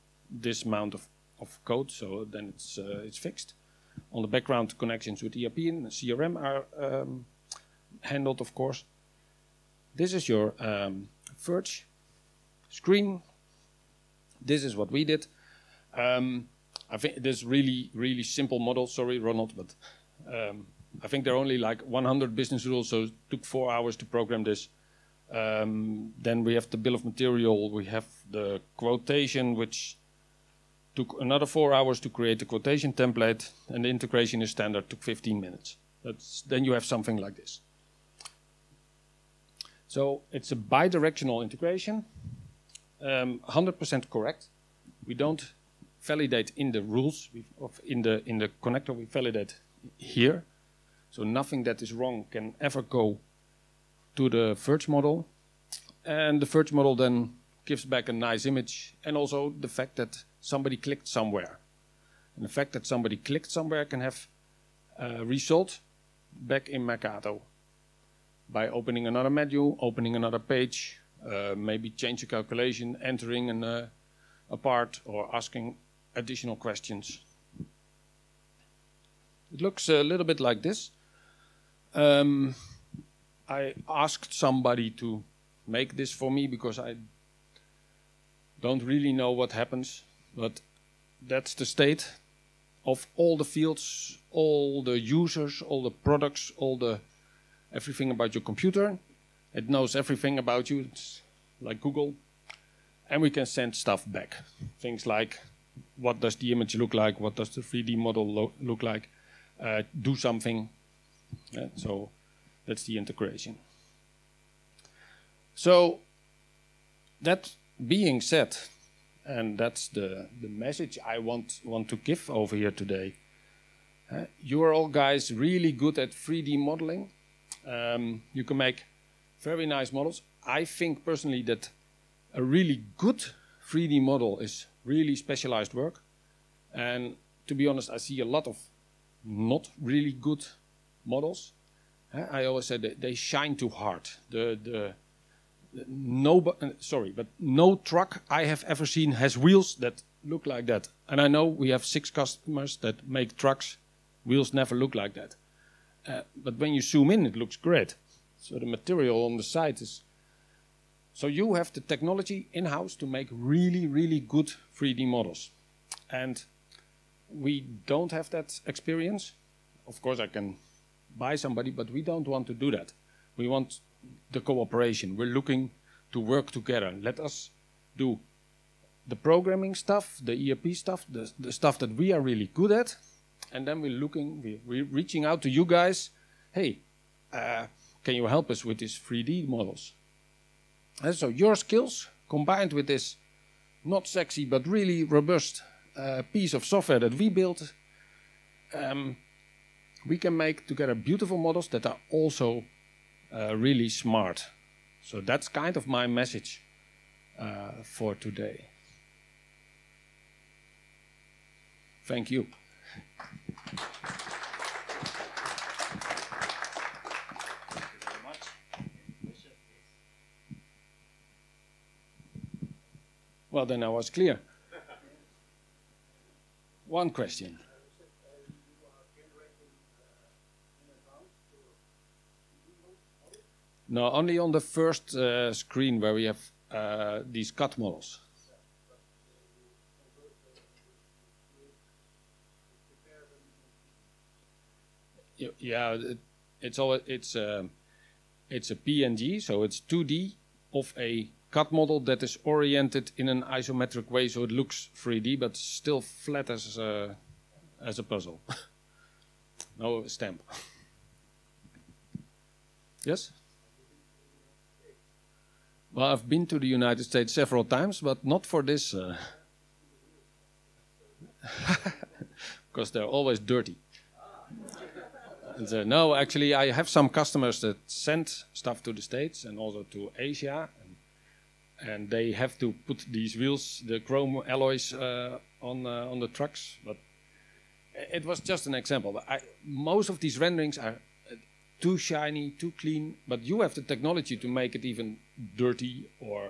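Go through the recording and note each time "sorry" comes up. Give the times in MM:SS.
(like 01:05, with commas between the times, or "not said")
00:18, 02:26.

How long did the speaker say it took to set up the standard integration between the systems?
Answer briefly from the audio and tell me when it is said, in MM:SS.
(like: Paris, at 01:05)
15 minutes, at 00:35.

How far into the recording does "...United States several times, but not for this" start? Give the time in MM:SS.
04:26.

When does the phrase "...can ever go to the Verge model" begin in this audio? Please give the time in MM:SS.
00:52.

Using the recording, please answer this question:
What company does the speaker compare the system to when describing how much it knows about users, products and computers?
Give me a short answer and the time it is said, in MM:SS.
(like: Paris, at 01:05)
Google, at 01:41.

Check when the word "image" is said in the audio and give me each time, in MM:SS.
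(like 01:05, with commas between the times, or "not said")
00:58, 01:46.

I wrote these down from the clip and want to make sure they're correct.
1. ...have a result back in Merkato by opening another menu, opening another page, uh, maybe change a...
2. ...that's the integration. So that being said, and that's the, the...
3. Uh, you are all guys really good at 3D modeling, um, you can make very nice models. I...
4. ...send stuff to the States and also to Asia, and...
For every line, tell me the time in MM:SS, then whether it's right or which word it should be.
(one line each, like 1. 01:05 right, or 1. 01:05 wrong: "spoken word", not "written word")
1. 01:04 right
2. 01:52 right
3. 02:04 right
4. 04:37 right.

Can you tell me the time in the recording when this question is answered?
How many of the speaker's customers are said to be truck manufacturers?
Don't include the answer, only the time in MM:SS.
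02:31.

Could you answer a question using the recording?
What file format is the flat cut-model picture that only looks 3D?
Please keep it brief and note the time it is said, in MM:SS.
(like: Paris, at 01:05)
PNG, at 04:08.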